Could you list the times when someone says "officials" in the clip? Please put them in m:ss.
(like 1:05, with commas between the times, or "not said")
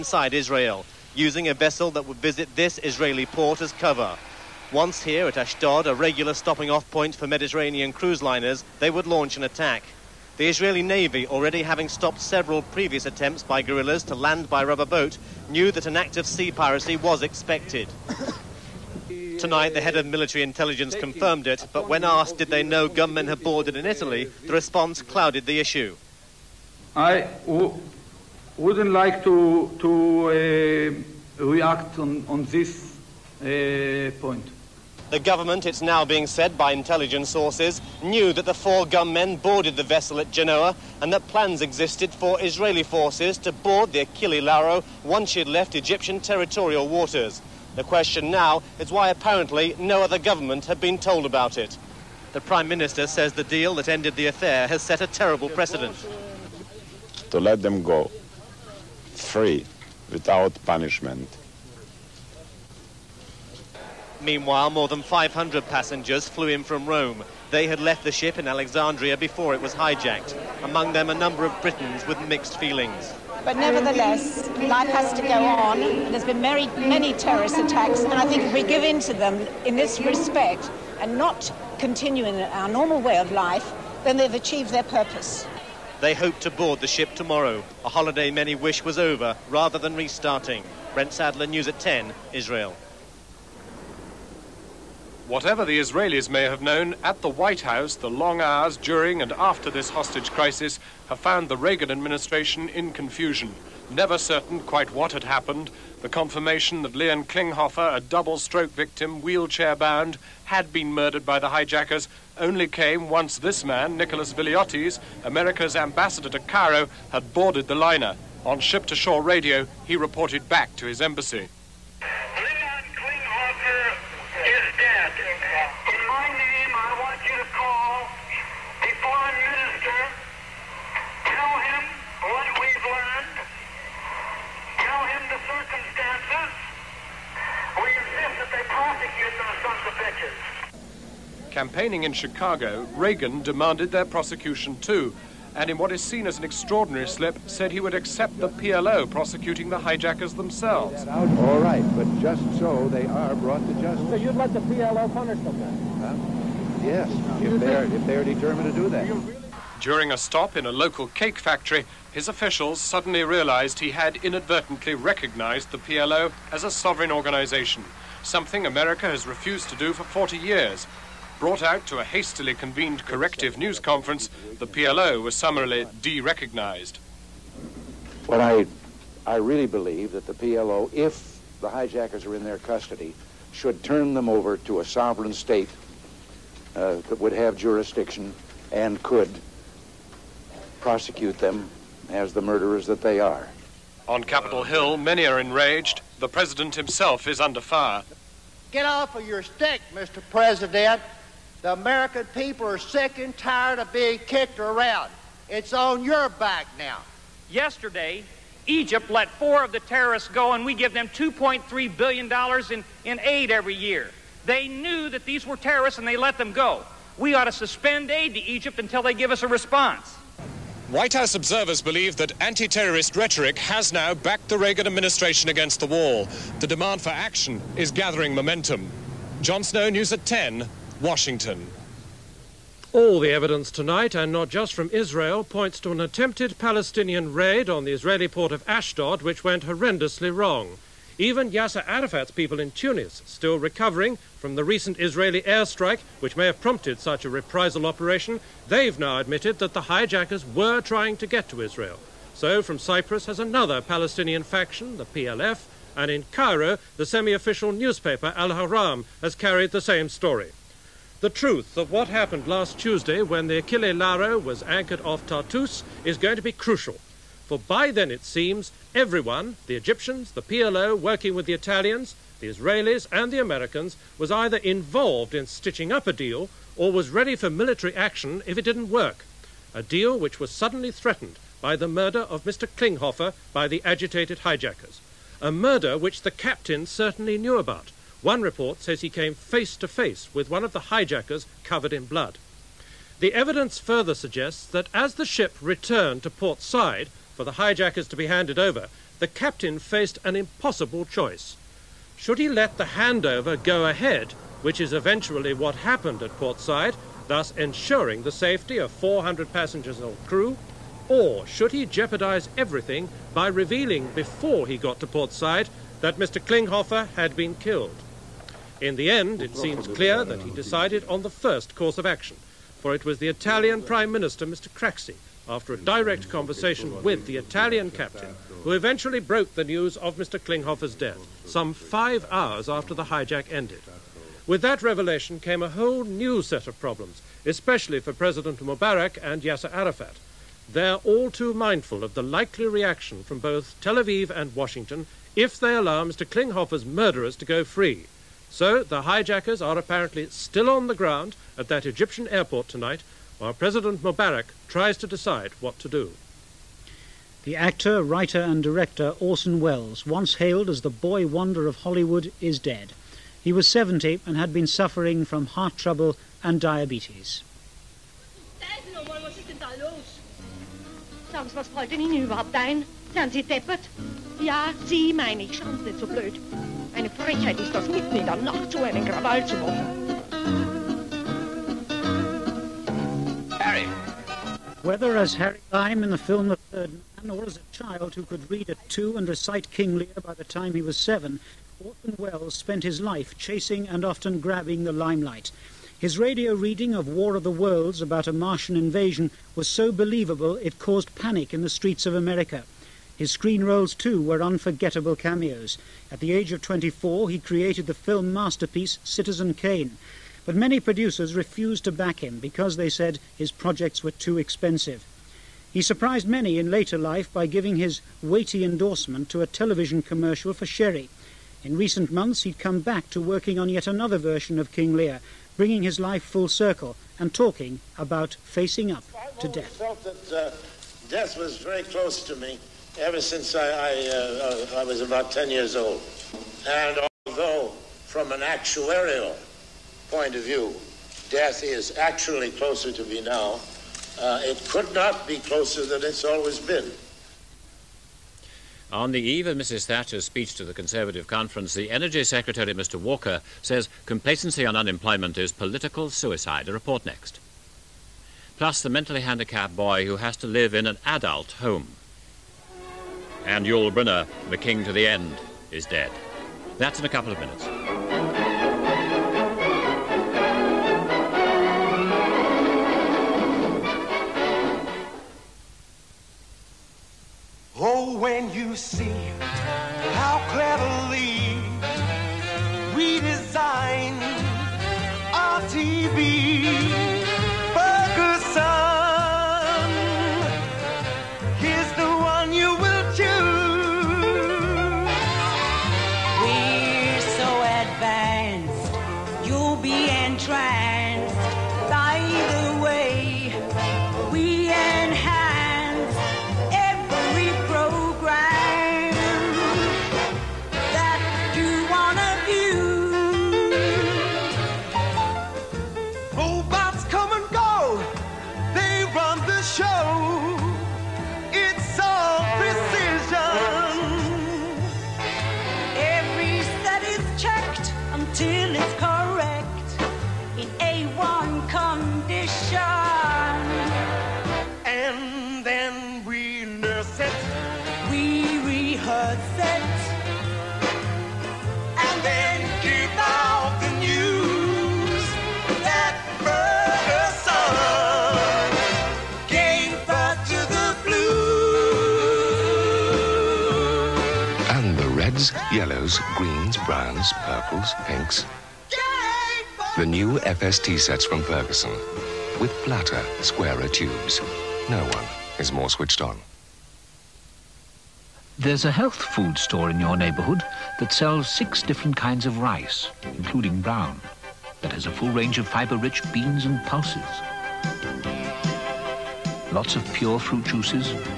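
2:42, 4:17.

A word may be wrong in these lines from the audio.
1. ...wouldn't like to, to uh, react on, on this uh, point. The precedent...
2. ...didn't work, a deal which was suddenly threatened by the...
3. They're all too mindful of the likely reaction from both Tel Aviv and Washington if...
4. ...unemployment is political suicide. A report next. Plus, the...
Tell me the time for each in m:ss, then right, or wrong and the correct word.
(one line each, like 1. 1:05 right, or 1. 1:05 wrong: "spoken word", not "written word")
1. 0:28 wrong: "government", not "precedent"
2. 4:38 right
3. 5:40 right
4. 7:34 right.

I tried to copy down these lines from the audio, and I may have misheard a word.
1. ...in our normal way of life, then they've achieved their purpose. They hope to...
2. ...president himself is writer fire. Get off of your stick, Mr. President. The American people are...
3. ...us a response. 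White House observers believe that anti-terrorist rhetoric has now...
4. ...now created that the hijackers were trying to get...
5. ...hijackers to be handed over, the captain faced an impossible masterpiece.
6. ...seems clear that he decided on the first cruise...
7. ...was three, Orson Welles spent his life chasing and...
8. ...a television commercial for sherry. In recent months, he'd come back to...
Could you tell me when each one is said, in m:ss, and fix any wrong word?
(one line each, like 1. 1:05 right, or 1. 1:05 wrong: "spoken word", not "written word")
1. 1:22 right
2. 3:16 wrong: "under", not "writer"
3. 3:39 right
4. 4:08 wrong: "admitted", not "created"
5. 4:57 wrong: "choice", not "masterpiece"
6. 5:19 wrong: "course", not "cruise"
7. 6:30 wrong: "seven", not "three"
8. 6:59 right.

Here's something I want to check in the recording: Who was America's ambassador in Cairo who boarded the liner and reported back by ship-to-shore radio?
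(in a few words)
Nicholas Veliotis.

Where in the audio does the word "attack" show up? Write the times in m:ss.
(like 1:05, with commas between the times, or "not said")
0:09, 1:17.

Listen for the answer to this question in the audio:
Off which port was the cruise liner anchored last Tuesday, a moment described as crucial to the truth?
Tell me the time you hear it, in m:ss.
4:25.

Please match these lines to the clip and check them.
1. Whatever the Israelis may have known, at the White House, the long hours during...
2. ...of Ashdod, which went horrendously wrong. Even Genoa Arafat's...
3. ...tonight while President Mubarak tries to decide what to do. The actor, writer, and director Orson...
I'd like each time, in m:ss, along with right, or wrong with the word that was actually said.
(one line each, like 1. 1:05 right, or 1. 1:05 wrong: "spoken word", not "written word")
1. 1:35 right
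2. 3:58 wrong: "Yasser", not "Genoa"
3. 5:52 right.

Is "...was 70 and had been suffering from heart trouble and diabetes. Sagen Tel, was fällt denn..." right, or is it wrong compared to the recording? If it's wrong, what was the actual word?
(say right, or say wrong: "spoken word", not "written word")
wrong: "Sie", not "Tel".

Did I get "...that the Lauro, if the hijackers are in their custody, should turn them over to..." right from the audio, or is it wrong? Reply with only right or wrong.
wrong.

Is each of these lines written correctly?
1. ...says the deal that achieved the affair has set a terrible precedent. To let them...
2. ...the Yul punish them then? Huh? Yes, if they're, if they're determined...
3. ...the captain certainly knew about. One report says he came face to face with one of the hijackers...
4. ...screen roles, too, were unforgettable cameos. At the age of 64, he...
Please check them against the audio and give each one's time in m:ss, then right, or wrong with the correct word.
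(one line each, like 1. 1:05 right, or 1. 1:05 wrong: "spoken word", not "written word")
1. 0:53 wrong: "ended", not "achieved"
2. 2:34 wrong: "PLO", not "Yul"
3. 4:46 right
4. 6:43 wrong: "24", not "64".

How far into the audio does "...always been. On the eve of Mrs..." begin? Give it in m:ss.
7:26.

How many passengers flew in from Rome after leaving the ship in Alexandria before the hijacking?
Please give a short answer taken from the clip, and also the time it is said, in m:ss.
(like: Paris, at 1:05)
500, at 1:05.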